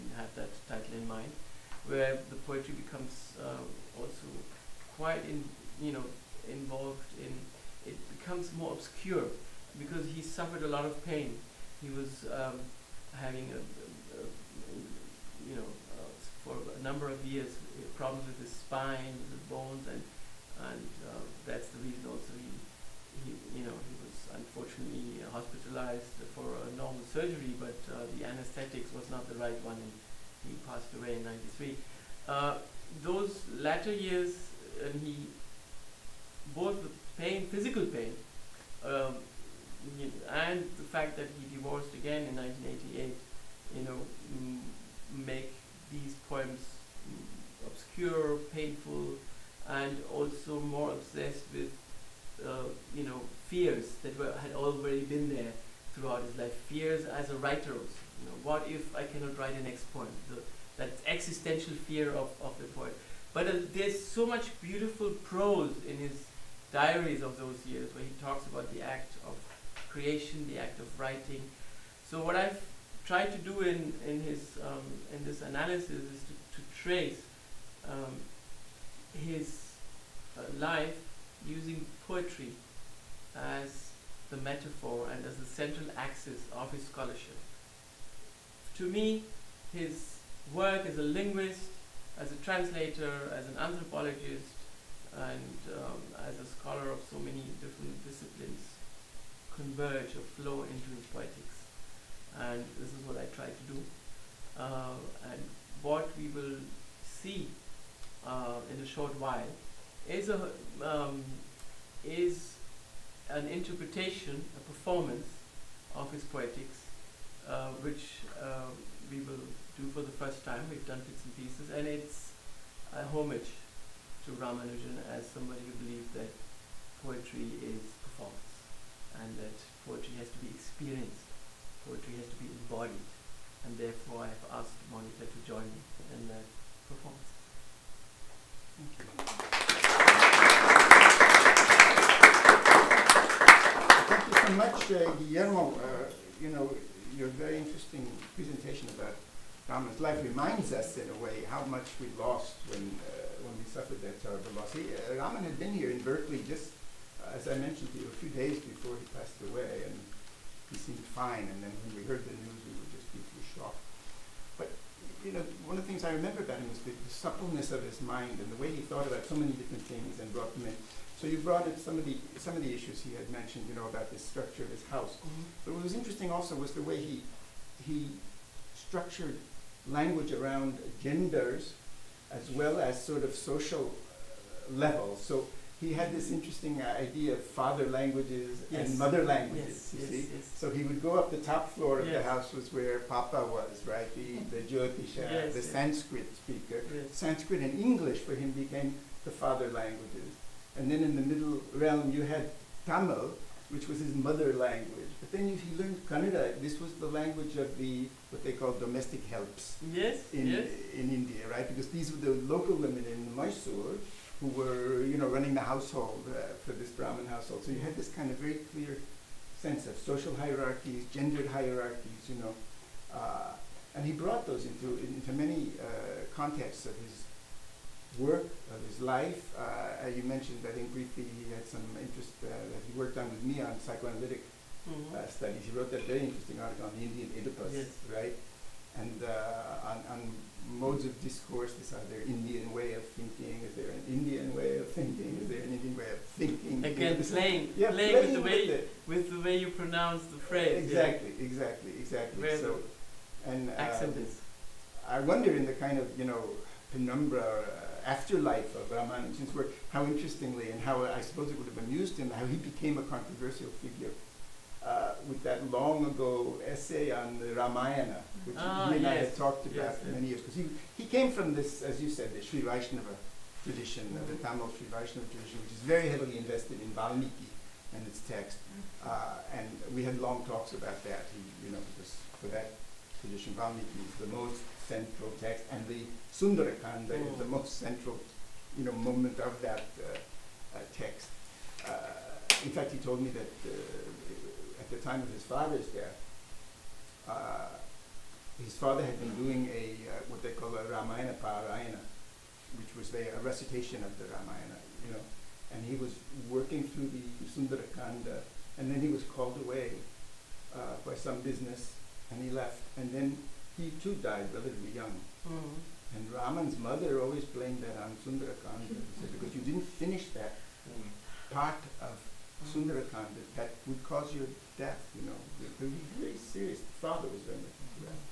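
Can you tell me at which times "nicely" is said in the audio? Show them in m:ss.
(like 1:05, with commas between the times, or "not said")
not said.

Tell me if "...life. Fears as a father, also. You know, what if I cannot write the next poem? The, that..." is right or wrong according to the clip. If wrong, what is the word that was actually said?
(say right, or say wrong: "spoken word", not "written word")
wrong: "writer", not "father".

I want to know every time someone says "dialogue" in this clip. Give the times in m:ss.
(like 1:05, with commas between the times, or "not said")
not said.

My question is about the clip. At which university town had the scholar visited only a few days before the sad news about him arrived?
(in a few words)
Berkeley.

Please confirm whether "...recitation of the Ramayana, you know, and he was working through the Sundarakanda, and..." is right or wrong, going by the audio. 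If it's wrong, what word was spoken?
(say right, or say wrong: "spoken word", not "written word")
right.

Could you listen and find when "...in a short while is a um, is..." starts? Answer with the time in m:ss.
1:48.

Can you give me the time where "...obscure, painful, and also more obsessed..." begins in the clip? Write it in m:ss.
0:47.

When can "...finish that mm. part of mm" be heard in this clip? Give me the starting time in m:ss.
5:20.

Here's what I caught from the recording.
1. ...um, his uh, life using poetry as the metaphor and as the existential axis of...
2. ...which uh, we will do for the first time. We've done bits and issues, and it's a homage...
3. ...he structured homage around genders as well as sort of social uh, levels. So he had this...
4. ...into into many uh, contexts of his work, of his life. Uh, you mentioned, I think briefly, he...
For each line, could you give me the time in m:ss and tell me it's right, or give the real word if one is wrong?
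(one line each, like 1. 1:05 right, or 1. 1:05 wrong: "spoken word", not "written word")
1. 1:17 wrong: "central", not "existential"
2. 1:57 wrong: "pieces", not "issues"
3. 2:57 wrong: "language", not "homage"
4. 3:44 right.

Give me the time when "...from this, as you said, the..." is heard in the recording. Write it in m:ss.
4:31.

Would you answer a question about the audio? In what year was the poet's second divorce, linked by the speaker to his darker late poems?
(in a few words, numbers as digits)
1988.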